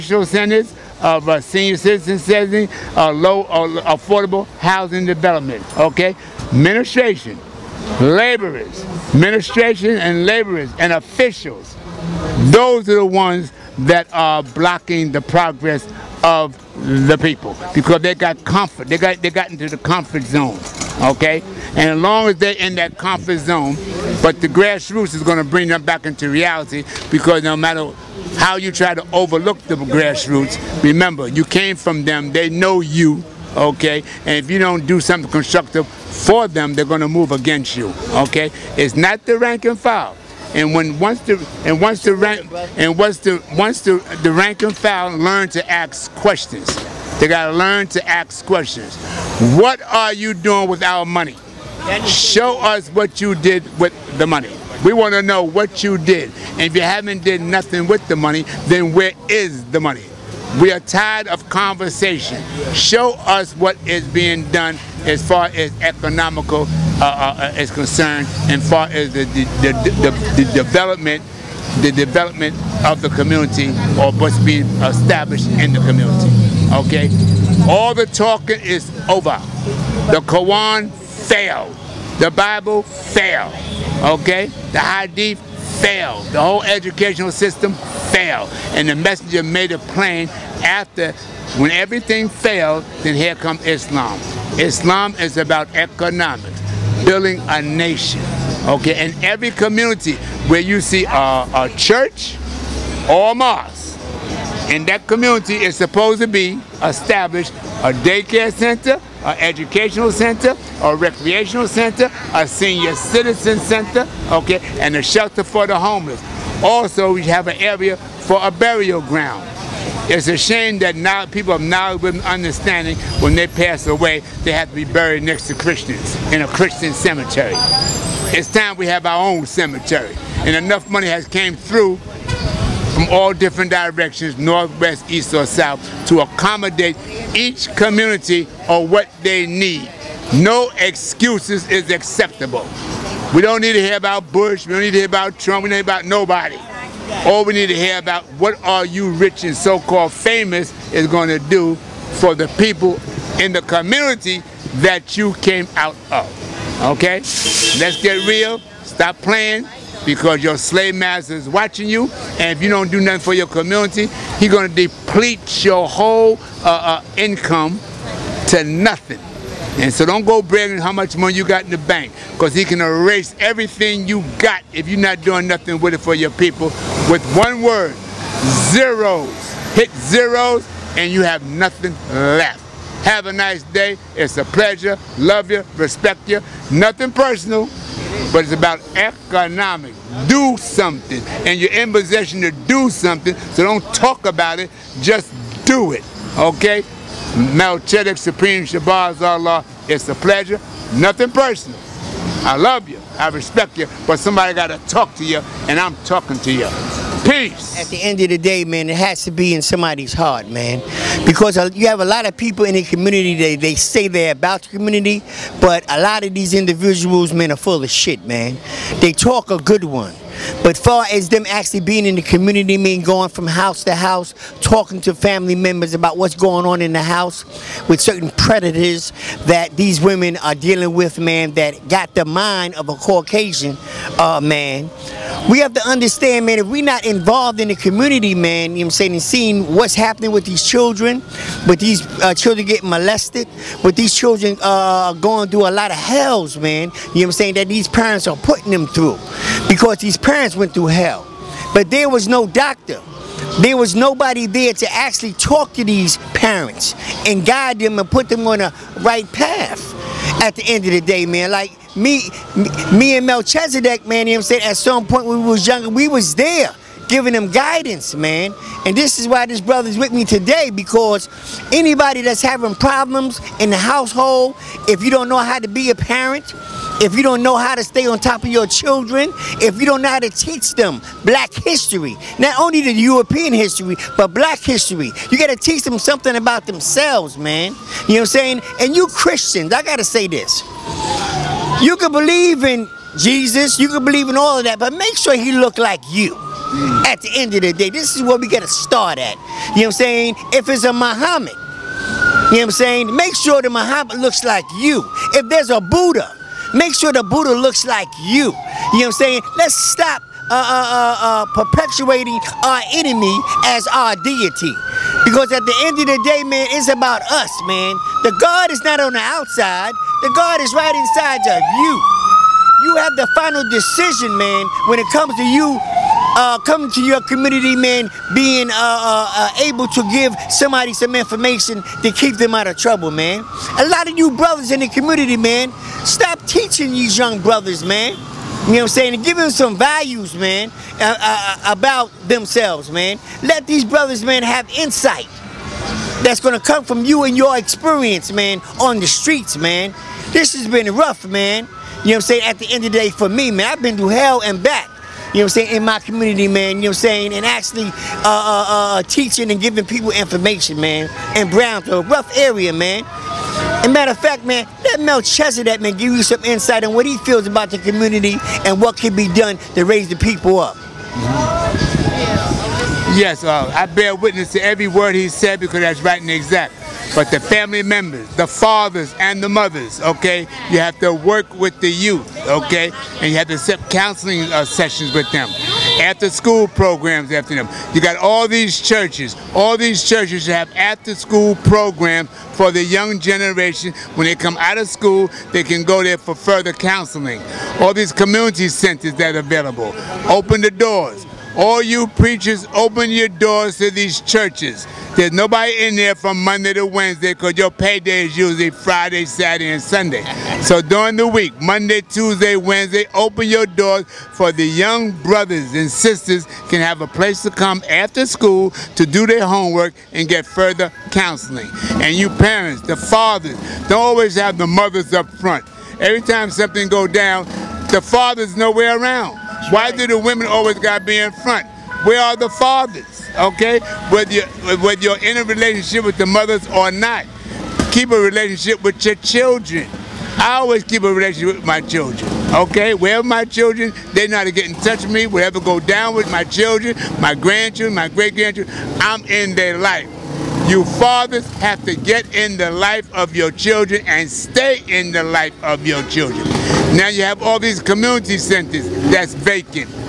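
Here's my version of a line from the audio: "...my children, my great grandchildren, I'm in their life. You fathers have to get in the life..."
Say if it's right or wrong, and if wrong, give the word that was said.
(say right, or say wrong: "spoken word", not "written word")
wrong: "grandchildren", not "children".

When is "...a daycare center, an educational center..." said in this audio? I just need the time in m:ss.
1:47.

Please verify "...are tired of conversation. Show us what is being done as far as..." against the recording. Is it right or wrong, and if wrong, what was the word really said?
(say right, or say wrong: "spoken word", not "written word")
right.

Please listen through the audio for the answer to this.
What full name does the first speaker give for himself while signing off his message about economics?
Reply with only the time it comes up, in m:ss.
3:17.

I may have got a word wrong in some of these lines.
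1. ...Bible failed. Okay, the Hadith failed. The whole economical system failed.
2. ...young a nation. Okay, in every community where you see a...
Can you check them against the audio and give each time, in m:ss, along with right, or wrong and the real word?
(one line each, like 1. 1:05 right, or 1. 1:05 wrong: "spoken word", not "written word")
1. 1:22 wrong: "educational", not "economical"
2. 1:37 wrong: "building", not "young".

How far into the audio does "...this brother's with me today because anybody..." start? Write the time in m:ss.
4:29.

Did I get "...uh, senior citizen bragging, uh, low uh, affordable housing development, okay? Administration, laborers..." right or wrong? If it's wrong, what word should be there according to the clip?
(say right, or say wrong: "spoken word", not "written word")
wrong: "housing", not "bragging".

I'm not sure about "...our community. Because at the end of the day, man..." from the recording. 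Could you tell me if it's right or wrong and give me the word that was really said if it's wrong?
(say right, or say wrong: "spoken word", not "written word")
wrong: "deity", not "community".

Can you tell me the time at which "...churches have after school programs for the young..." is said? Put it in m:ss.
6:30.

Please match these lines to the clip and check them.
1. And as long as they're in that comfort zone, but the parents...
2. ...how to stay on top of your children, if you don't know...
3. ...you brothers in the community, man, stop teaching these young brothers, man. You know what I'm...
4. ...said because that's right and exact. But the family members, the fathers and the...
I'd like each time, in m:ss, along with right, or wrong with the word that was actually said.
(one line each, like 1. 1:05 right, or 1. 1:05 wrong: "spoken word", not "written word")
1. 0:21 wrong: "grassroots", not "parents"
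2. 4:37 right
3. 5:34 right
4. 6:15 right.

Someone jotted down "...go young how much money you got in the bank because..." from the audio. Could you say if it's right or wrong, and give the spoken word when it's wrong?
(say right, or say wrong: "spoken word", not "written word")
wrong: "bragging", not "young".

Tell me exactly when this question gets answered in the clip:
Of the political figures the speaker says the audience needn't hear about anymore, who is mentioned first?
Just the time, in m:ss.
2:24.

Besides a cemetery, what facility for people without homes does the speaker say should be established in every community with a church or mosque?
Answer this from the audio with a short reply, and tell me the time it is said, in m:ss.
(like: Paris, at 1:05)
A shelter for the homeless, at 1:54.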